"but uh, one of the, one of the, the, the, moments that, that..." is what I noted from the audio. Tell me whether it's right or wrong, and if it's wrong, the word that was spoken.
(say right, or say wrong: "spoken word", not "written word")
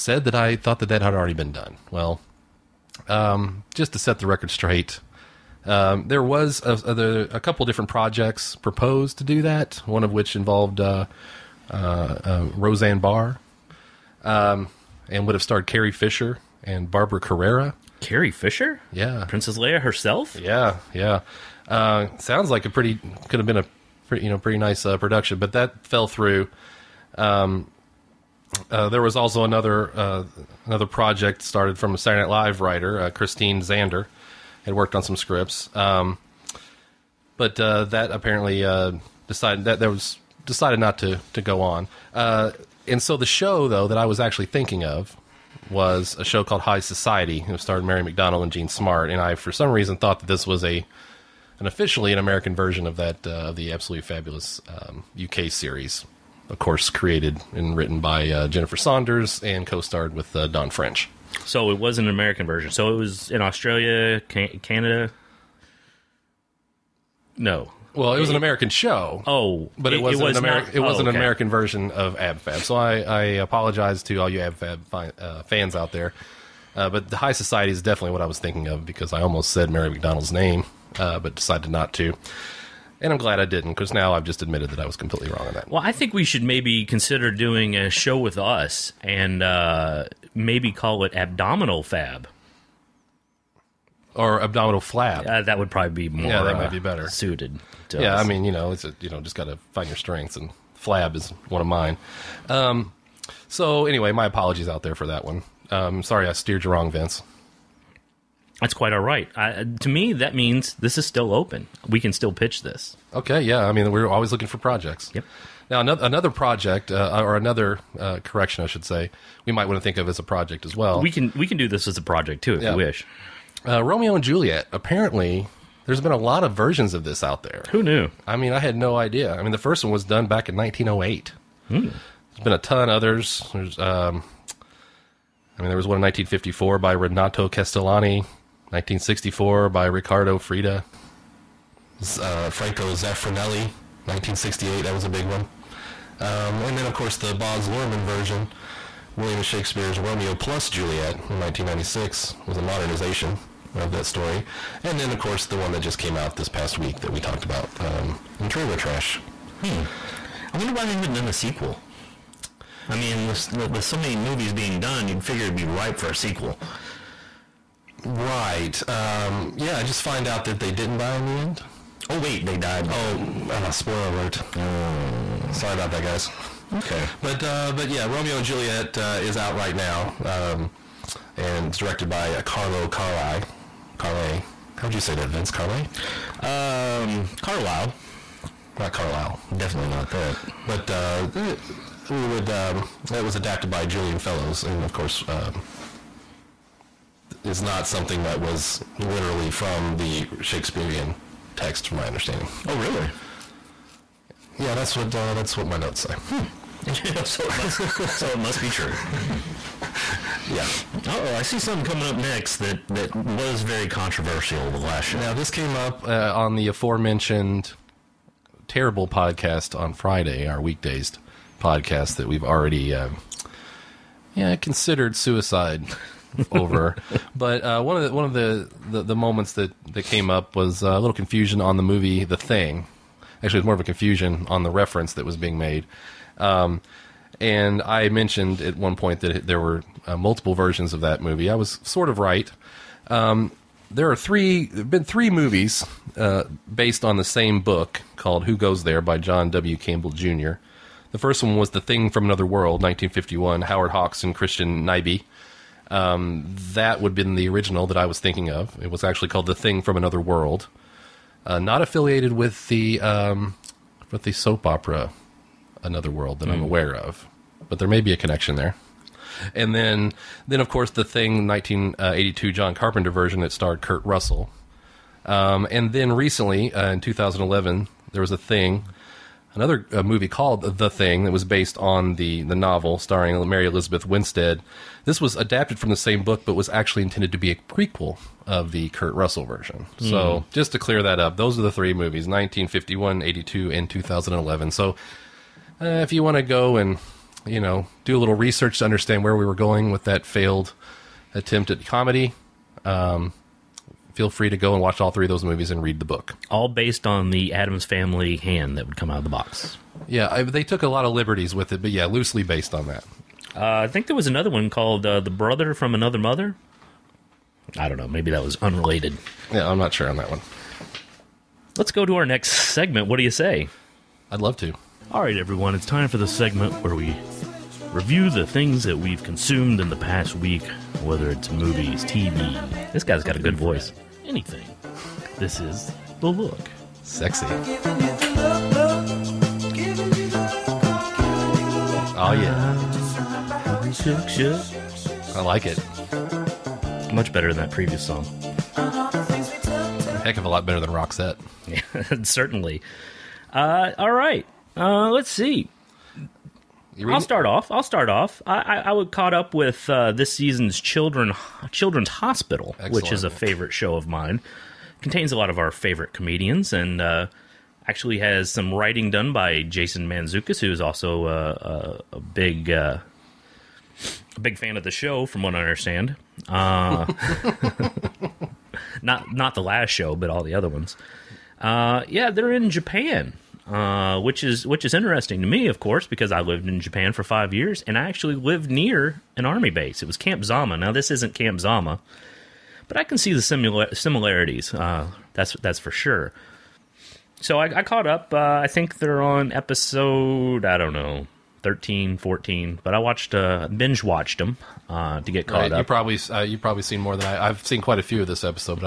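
right.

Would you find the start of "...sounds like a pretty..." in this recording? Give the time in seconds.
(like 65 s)
22 s.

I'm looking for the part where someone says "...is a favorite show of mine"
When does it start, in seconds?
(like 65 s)
363 s.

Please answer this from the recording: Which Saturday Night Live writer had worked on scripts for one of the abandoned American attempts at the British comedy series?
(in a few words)
Christine Zander.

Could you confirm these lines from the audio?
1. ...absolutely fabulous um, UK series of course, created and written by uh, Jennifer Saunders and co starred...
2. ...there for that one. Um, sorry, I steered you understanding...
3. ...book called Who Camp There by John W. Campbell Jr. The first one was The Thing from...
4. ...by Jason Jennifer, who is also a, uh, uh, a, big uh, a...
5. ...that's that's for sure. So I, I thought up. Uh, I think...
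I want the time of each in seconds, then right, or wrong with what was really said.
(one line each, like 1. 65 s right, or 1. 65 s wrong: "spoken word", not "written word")
1. 53 s right
2. 104 s wrong: "wrong", not "understanding"
3. 247 s wrong: "Goes", not "Camp"
4. 369 s wrong: "Mantzoukas", not "Jennifer"
5. 395 s wrong: "caught", not "thought".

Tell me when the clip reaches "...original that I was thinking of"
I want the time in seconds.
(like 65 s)
257 s.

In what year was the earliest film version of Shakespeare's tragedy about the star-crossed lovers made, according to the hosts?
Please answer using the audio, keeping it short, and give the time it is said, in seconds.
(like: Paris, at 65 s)
1908, at 130 s.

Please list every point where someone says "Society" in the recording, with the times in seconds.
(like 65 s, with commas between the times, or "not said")
46 s, 77 s.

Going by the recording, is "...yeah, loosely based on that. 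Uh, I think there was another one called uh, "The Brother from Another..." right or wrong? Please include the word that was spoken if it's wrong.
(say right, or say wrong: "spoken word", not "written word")
right.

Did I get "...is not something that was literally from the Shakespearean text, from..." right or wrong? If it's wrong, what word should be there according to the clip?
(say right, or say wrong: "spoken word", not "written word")
right.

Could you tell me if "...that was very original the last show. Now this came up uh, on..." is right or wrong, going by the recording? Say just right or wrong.
wrong.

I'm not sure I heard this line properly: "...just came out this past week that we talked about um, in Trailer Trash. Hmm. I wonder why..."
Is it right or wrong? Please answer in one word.
right.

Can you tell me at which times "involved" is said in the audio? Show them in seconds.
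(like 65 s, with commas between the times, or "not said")
10 s.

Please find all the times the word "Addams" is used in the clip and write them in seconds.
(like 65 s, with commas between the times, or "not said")
307 s.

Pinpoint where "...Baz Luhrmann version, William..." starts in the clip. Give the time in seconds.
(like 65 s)
147 s.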